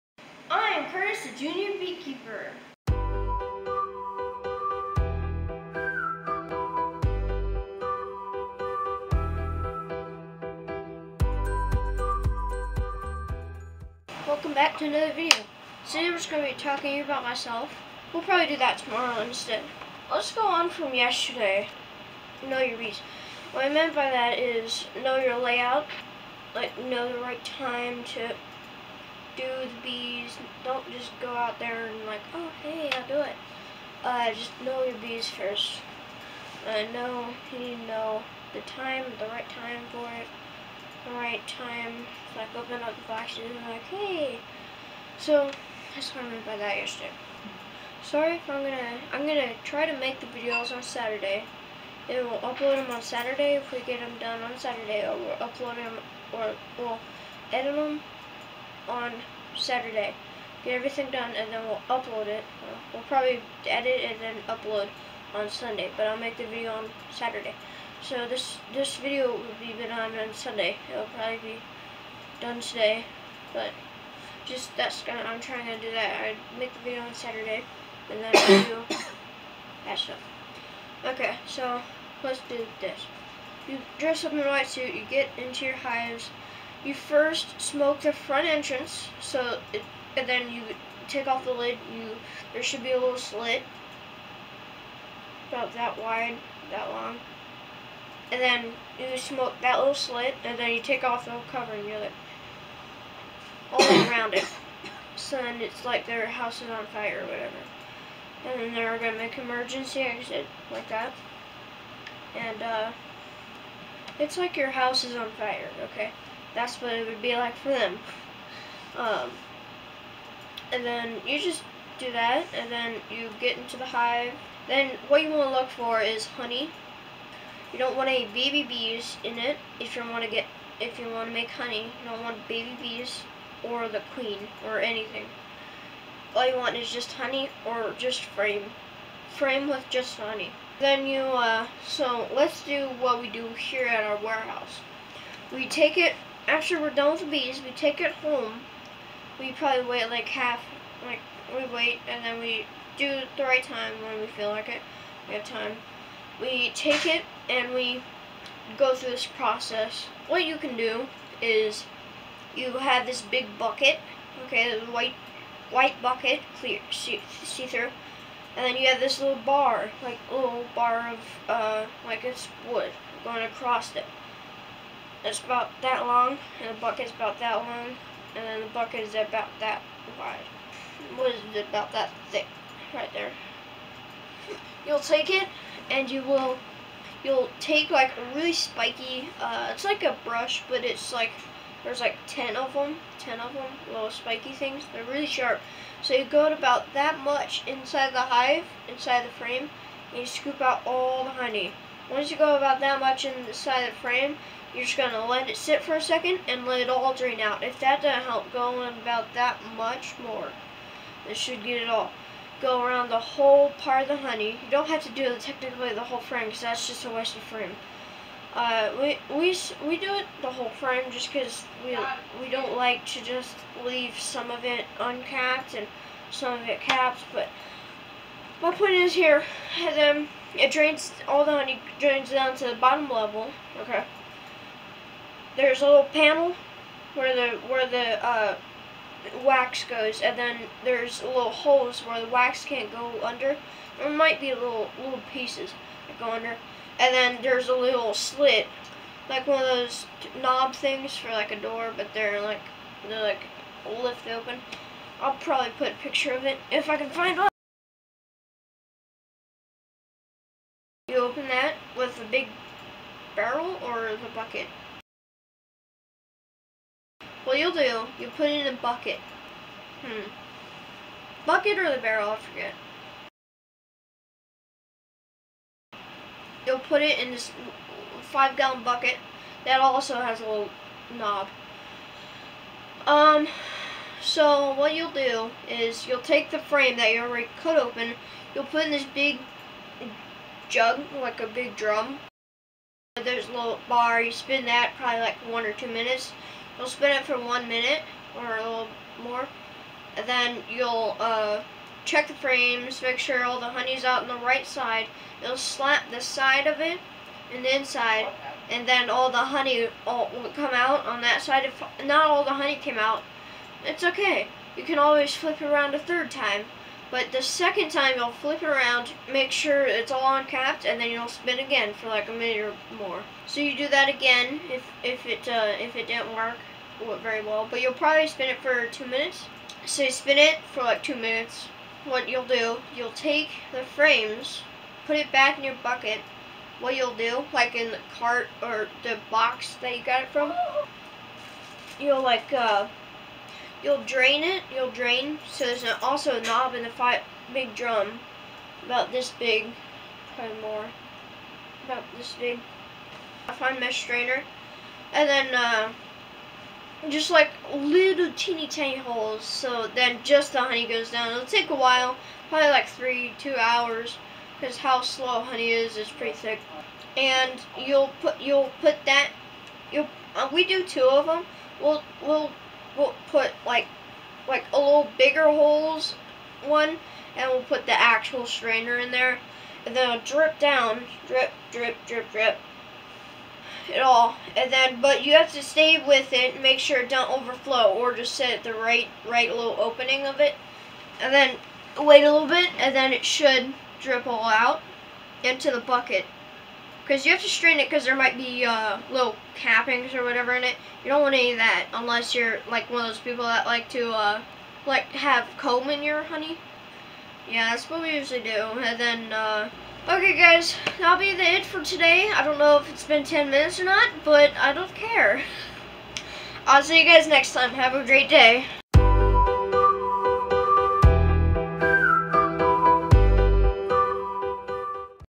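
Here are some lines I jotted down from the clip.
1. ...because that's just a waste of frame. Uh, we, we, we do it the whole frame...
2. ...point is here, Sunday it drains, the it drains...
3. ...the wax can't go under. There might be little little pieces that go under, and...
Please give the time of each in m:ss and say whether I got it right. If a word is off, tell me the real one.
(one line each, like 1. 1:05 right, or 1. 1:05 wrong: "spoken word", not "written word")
1. 3:36 right
2. 3:48 wrong: "Then", not "Sunday"
3. 4:02 right.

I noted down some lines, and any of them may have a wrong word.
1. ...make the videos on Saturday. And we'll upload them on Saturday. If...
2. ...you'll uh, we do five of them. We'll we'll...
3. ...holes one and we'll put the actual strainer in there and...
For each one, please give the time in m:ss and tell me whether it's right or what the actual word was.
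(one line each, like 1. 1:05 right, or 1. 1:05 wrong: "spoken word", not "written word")
1. 0:49 right
2. 6:09 wrong: "two", not "five"
3. 6:15 right.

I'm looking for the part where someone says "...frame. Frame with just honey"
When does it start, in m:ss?
2:18.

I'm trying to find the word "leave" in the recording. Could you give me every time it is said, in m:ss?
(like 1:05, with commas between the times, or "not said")
3:43.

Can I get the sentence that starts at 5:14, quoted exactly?
You can always flip it around a third time.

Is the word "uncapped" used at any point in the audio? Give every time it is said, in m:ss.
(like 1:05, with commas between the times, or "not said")
3:44, 5:20.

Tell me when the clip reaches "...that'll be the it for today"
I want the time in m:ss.
6:50.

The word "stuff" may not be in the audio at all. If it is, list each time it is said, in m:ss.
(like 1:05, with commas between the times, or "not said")
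1:19.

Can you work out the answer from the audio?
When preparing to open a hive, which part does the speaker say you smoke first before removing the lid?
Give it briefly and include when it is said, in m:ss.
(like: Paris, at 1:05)
The front entrance, at 1:28.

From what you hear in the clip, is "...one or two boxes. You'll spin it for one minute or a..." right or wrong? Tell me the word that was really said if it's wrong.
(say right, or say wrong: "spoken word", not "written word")
wrong: "minutes", not "boxes".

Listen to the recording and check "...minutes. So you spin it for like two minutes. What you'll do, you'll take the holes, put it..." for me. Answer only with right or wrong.
wrong.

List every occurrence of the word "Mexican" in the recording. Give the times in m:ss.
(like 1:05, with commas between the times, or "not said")
not said.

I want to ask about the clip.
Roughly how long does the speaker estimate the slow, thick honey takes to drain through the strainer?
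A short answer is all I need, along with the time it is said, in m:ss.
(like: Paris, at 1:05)
About 2 to 3 hours, at 6:02.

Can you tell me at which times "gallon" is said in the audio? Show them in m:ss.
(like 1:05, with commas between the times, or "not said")
4:38.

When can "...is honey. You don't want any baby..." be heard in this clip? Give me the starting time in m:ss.
2:06.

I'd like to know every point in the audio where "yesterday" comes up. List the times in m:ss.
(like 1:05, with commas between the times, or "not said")
0:20, 0:46.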